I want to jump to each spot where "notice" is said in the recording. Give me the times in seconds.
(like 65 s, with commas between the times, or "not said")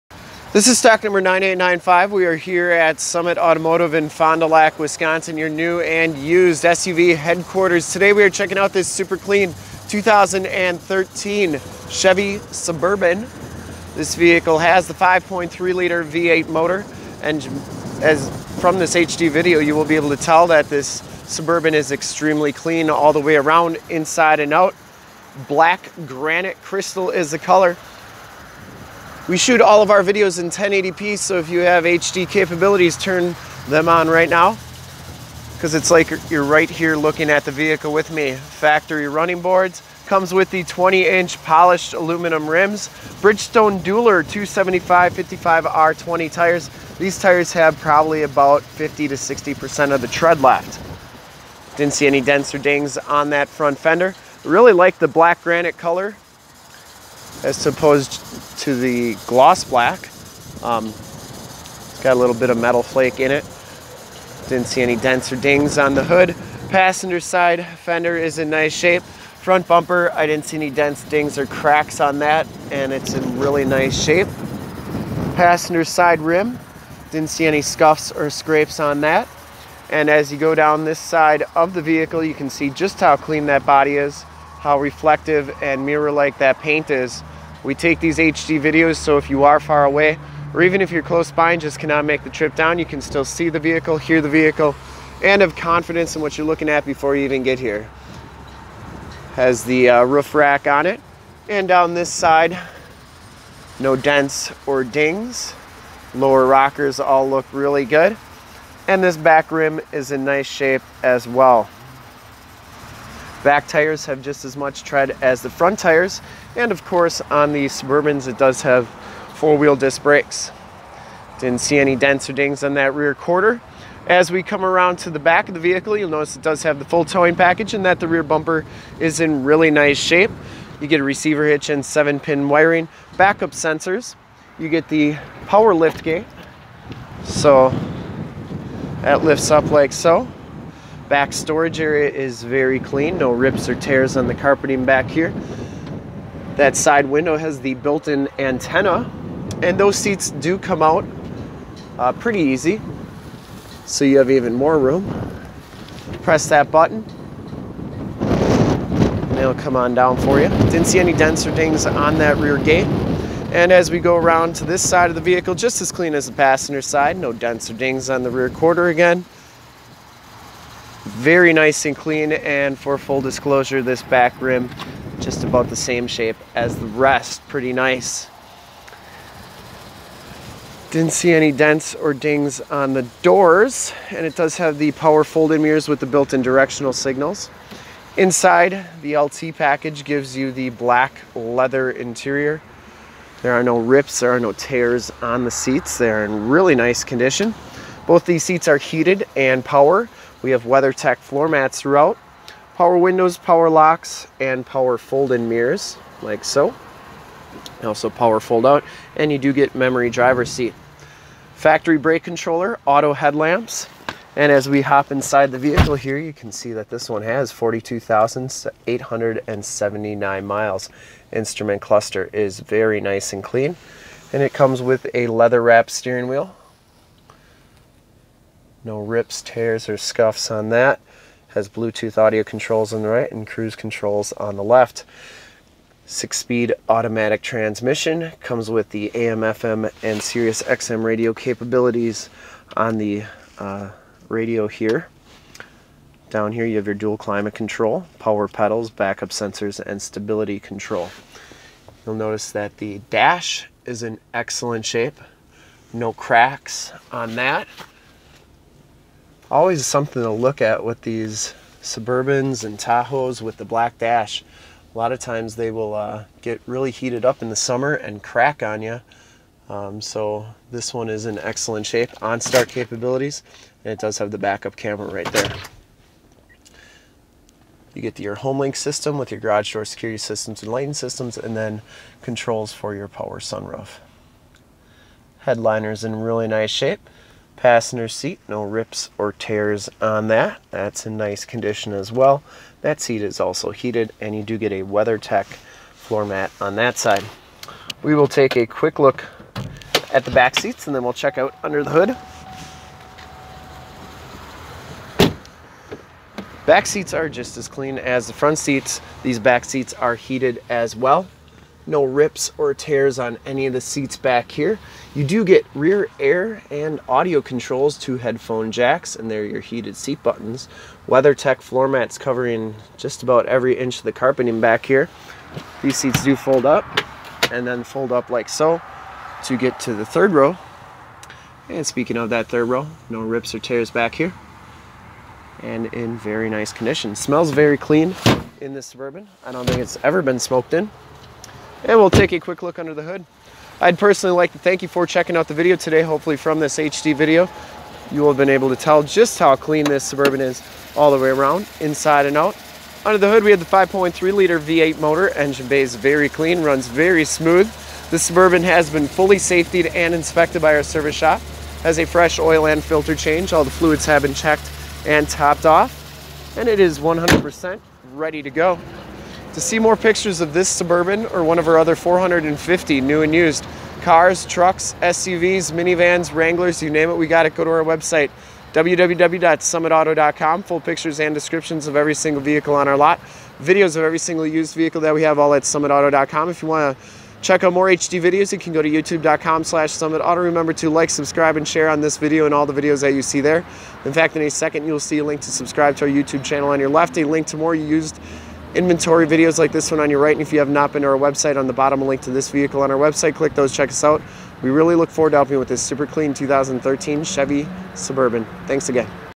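126 s, 252 s.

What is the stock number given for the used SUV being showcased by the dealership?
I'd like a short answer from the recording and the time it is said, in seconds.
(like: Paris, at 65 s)
9895, at 1 s.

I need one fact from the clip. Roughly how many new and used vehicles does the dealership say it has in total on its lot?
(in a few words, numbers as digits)
450.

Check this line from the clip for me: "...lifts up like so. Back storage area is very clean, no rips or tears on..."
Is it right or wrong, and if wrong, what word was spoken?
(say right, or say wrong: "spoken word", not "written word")
right.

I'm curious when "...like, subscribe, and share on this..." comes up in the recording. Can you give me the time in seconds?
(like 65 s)
390 s.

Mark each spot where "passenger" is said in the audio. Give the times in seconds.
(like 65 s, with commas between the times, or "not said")
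66 s, 75 s, 166 s, 287 s.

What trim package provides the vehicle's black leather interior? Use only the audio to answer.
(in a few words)
LT.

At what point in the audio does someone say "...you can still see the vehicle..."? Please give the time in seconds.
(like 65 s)
92 s.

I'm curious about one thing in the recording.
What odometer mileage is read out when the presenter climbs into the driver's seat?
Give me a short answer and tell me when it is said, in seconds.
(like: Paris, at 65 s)
42,879, at 217 s.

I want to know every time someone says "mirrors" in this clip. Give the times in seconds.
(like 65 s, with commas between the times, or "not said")
85 s, 185 s, 205 s.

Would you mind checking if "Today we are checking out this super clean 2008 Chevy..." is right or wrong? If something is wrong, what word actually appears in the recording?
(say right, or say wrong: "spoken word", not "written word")
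wrong: "2013", not "2008".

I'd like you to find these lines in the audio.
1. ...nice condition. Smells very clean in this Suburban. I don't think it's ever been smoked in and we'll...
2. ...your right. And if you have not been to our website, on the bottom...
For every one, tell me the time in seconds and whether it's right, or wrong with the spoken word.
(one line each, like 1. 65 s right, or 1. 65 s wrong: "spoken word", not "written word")
1. 336 s right
2. 400 s right.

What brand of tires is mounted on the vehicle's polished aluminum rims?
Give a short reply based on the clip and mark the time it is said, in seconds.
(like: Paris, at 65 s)
Bridgestone Dueler, at 43 s.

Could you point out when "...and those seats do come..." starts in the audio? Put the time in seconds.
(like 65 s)
149 s.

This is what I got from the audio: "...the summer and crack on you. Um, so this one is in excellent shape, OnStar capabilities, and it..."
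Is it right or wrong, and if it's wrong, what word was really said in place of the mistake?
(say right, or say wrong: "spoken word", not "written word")
right.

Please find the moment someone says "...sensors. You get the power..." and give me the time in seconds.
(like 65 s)
133 s.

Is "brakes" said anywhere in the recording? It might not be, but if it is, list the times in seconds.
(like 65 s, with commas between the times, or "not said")
120 s, 211 s.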